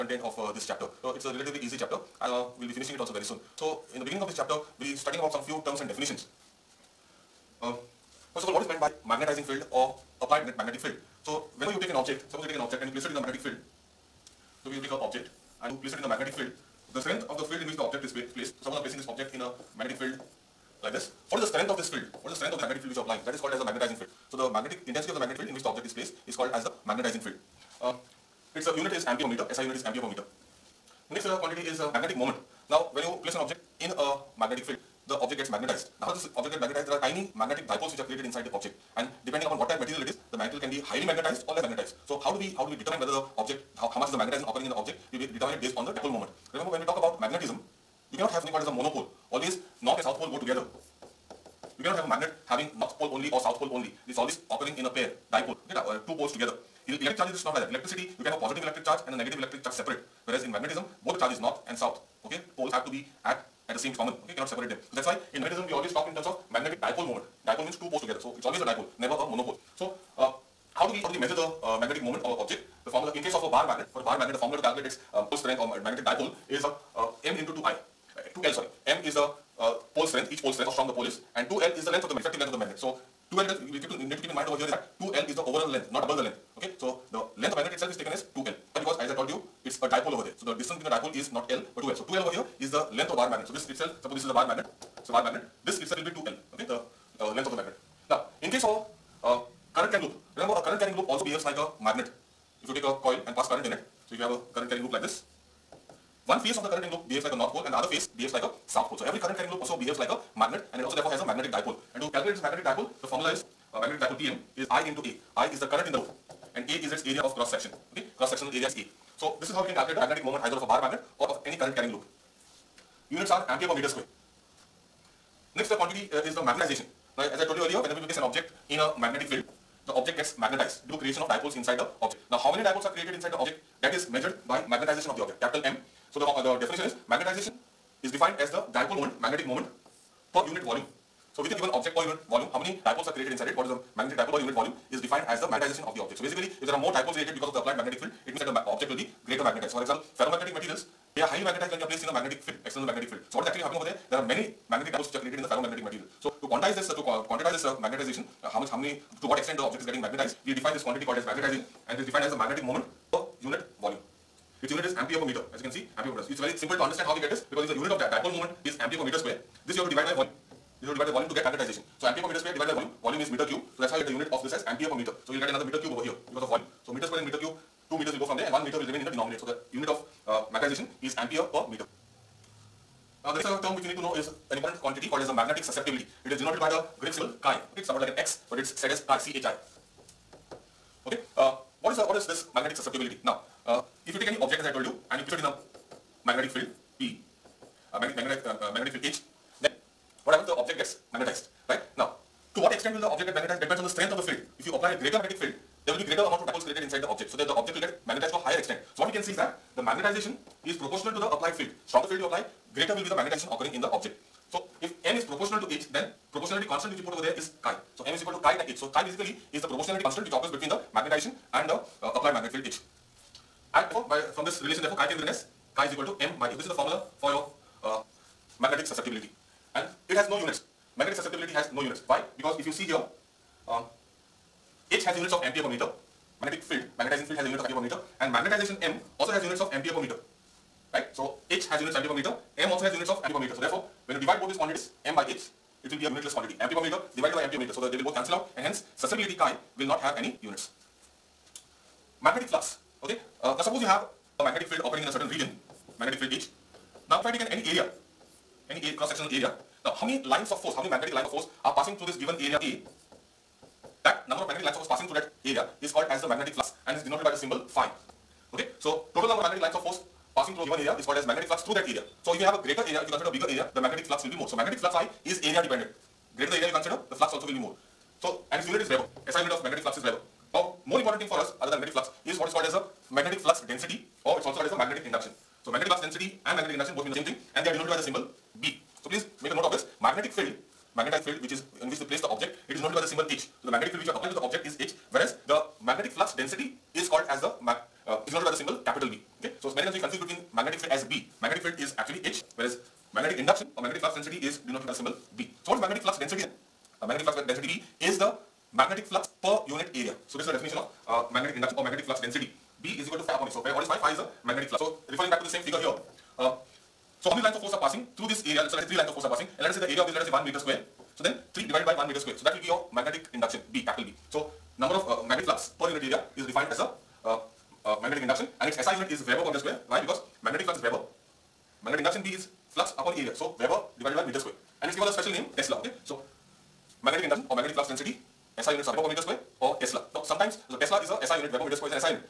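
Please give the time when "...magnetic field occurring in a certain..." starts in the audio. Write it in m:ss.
4:14.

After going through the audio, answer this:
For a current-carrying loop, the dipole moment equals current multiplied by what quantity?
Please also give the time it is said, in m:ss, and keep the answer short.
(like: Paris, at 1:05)
area of cross section, at 1:57.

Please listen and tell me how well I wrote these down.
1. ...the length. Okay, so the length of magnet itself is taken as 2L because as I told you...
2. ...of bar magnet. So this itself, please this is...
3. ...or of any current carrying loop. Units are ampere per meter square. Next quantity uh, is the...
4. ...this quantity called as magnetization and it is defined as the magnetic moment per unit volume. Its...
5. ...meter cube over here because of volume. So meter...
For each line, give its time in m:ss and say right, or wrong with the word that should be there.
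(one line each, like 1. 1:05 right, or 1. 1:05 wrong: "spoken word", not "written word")
1. 1:26 right
2. 1:33 wrong: "suppose", not "please"
3. 2:01 right
4. 2:40 right
5. 2:55 right.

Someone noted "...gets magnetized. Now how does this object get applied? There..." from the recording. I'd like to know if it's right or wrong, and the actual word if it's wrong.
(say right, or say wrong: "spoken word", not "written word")
wrong: "magnetized", not "applied".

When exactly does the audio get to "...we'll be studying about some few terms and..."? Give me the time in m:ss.
0:04.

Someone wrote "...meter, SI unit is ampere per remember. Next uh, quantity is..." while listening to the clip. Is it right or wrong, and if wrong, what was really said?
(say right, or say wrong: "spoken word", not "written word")
wrong: "meter", not "remember".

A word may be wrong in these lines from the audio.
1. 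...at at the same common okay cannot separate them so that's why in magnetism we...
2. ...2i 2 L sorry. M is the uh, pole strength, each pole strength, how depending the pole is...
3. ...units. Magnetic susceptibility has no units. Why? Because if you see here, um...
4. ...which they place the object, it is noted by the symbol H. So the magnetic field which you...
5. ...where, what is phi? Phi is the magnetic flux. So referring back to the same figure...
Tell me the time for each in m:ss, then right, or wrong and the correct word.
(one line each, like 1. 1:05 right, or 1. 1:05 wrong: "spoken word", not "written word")
1. 1:03 right
2. 1:17 wrong: "strong", not "depending"
3. 3:50 right
4. 4:51 right
5. 5:13 right.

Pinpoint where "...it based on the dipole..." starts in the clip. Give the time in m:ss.
0:45.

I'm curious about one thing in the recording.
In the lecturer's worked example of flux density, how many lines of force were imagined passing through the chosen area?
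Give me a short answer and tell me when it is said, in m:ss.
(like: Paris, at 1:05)
3, at 5:18.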